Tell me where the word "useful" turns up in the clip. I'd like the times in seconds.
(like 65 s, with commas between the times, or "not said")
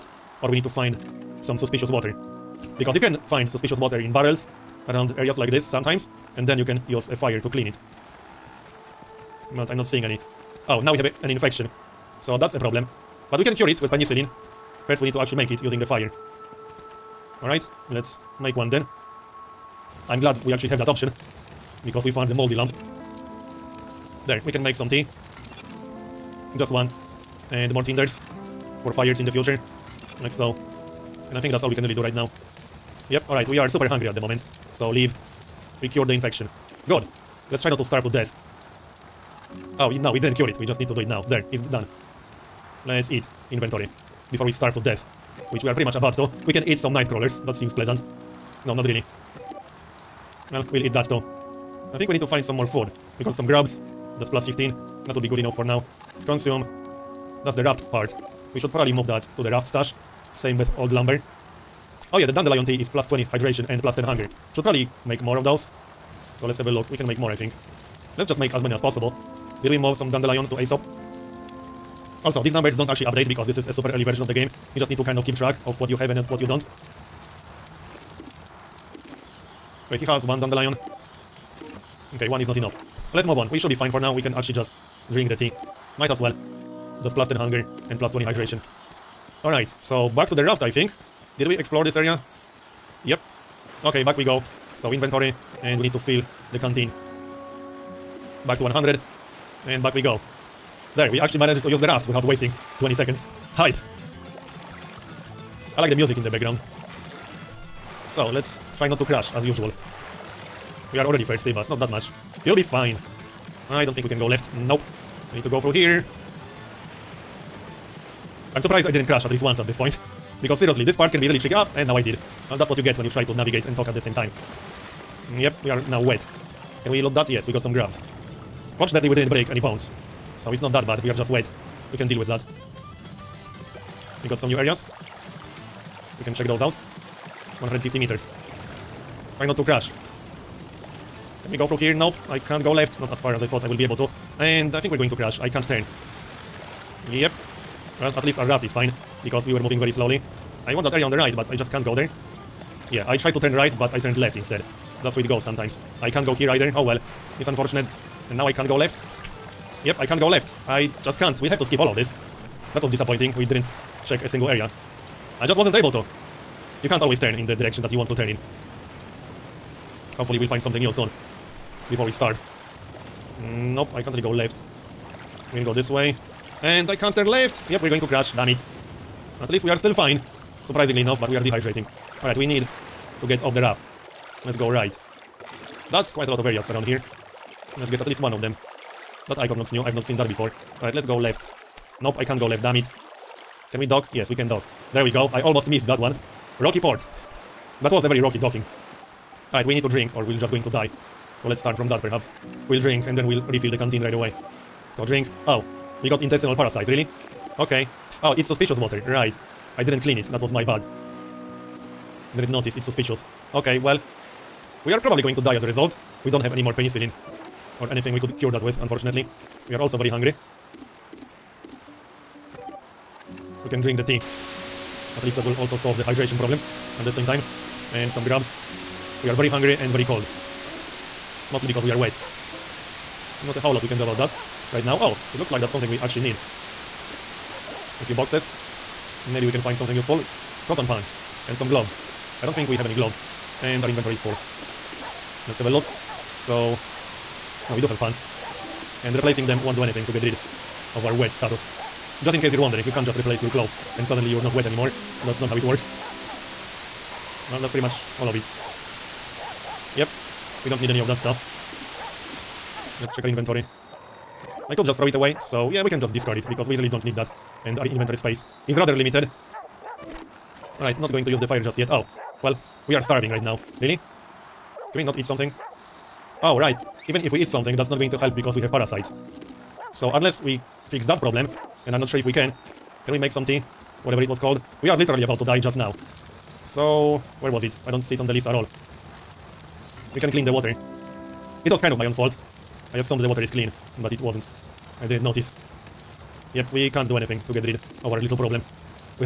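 239 s.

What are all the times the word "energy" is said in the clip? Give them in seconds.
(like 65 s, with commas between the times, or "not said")
not said.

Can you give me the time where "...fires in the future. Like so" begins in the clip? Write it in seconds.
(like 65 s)
28 s.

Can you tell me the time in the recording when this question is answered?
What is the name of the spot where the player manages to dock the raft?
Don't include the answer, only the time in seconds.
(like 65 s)
196 s.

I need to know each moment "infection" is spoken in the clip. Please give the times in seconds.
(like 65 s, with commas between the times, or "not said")
11 s, 36 s.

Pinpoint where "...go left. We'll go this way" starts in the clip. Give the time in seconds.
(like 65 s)
174 s.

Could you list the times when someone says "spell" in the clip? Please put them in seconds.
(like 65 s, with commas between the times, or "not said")
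not said.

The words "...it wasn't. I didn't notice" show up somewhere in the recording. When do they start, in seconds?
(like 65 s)
294 s.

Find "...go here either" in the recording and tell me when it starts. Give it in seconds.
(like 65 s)
156 s.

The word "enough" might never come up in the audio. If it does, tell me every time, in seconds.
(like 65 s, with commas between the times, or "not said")
55 s, 82 s, 181 s.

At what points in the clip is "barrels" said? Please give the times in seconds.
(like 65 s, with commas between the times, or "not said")
4 s.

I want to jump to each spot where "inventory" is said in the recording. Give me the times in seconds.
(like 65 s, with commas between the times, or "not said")
43 s, 94 s, 243 s, 263 s, 267 s.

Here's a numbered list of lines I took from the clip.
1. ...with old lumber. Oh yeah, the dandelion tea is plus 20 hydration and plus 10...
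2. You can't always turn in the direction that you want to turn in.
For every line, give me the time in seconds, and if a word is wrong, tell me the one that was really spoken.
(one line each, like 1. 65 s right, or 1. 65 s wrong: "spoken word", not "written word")
1. 60 s right
2. 166 s right.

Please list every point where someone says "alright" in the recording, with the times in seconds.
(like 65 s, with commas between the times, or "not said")
17 s, 33 s, 89 s, 182 s, 190 s, 199 s, 270 s.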